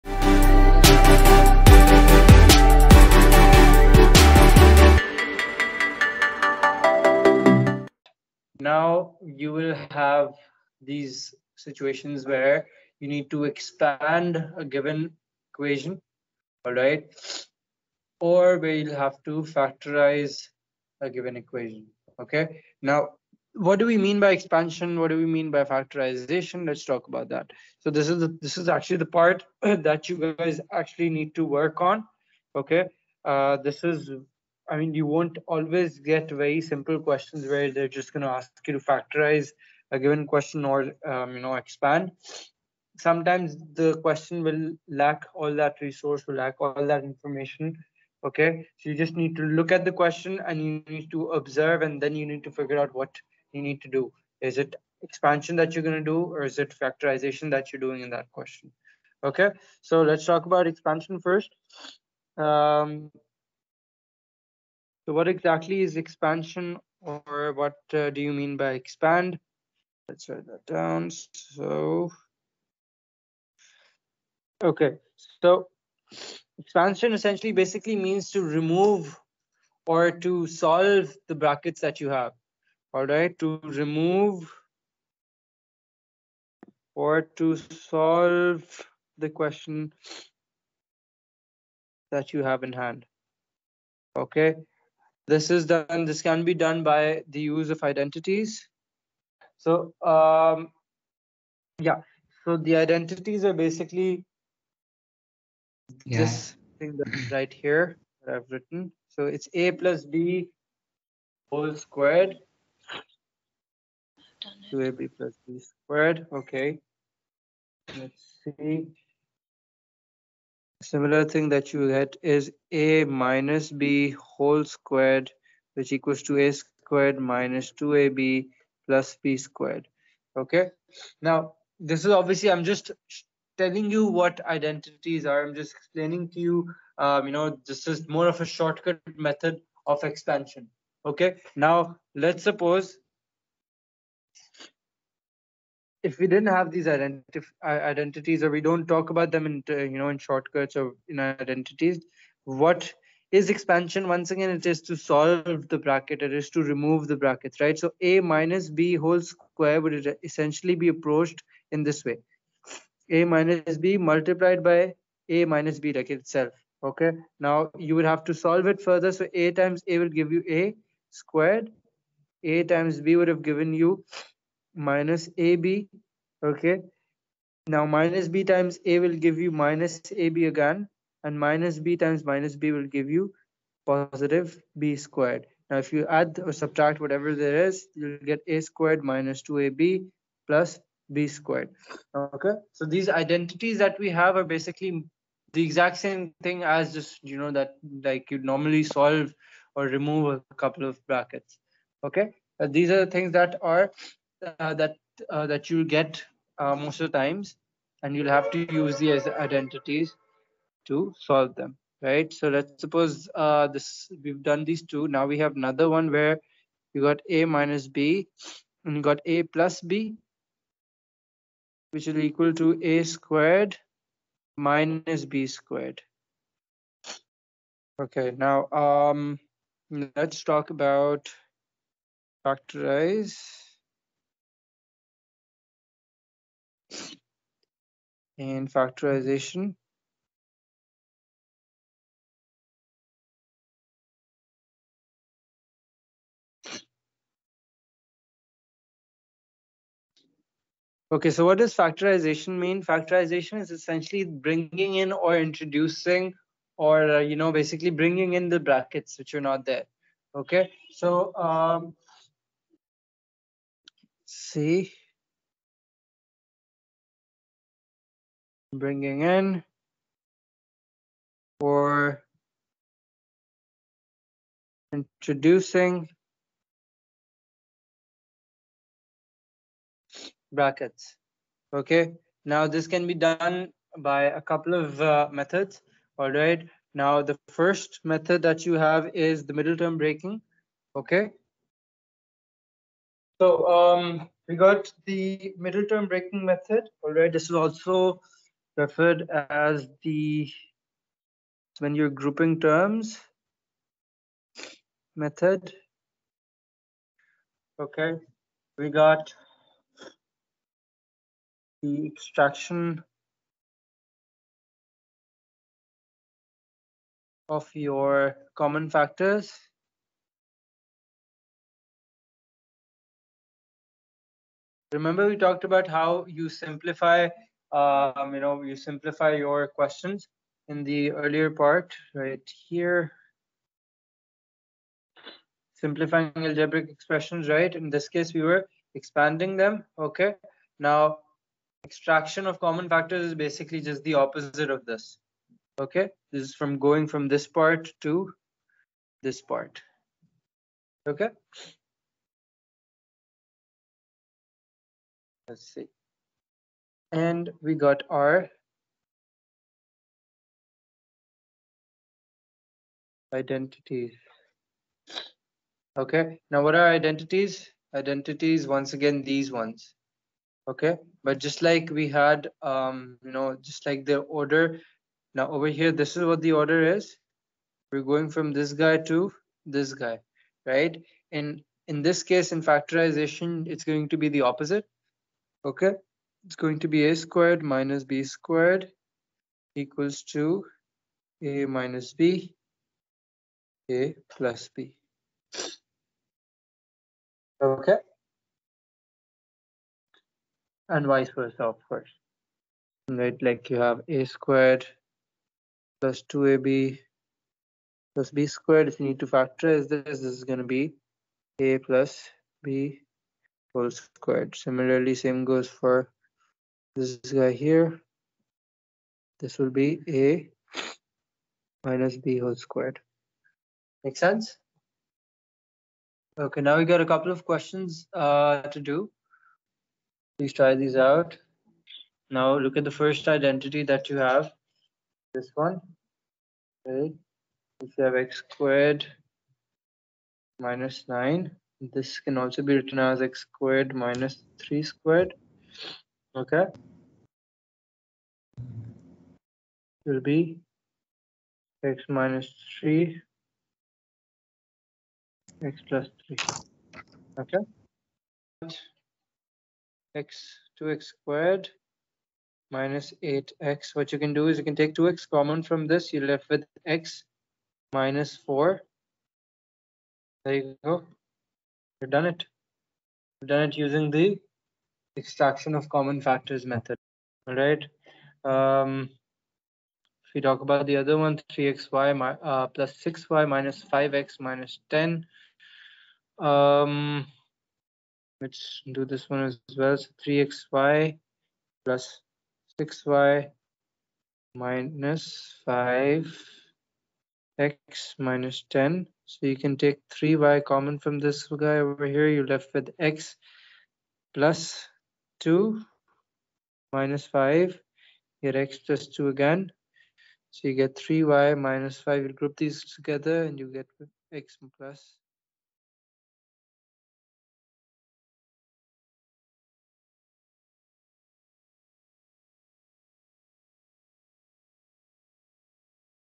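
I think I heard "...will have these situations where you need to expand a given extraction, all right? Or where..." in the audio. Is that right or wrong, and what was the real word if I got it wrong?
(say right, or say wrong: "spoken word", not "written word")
wrong: "equation", not "extraction".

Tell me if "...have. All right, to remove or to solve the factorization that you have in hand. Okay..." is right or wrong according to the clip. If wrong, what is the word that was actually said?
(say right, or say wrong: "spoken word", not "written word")
wrong: "question", not "factorization".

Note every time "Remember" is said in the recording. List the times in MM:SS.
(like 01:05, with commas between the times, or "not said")
05:24.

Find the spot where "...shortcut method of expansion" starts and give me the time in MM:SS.
02:18.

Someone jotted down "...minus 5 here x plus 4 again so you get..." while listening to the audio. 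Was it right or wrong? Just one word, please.
wrong.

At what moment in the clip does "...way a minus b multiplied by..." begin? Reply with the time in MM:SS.
02:42.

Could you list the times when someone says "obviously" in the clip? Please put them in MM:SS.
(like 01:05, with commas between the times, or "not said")
02:12.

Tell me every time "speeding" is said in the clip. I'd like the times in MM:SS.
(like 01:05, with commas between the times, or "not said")
not said.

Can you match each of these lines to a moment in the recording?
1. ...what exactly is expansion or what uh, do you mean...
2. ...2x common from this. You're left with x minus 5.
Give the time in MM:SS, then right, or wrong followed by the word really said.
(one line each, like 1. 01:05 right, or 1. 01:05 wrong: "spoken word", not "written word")
1. 01:05 right
2. 07:44 wrong: "4", not "5".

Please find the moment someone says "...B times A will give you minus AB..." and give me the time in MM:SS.
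02:58.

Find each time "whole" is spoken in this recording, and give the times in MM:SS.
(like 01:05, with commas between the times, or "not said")
01:51, 02:04, 02:38, 06:53, 07:02.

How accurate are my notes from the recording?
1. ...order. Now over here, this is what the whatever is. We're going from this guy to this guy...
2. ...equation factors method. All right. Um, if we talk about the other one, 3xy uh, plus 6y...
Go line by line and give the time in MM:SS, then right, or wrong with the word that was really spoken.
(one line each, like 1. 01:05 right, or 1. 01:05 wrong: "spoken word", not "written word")
1. 06:14 wrong: "order", not "whatever"
2. 07:55 wrong: "common", not "equation".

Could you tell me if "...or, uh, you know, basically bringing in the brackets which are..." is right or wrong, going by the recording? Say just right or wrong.
right.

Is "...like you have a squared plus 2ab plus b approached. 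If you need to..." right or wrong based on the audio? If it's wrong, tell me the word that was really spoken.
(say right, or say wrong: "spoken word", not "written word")
wrong: "squared", not "approached".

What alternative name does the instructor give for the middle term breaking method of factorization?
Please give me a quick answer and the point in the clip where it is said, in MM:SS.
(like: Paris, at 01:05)
Grouping terms method, at 05:02.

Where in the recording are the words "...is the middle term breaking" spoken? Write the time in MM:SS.
04:49.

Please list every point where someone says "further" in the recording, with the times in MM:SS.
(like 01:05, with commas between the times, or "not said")
02:48.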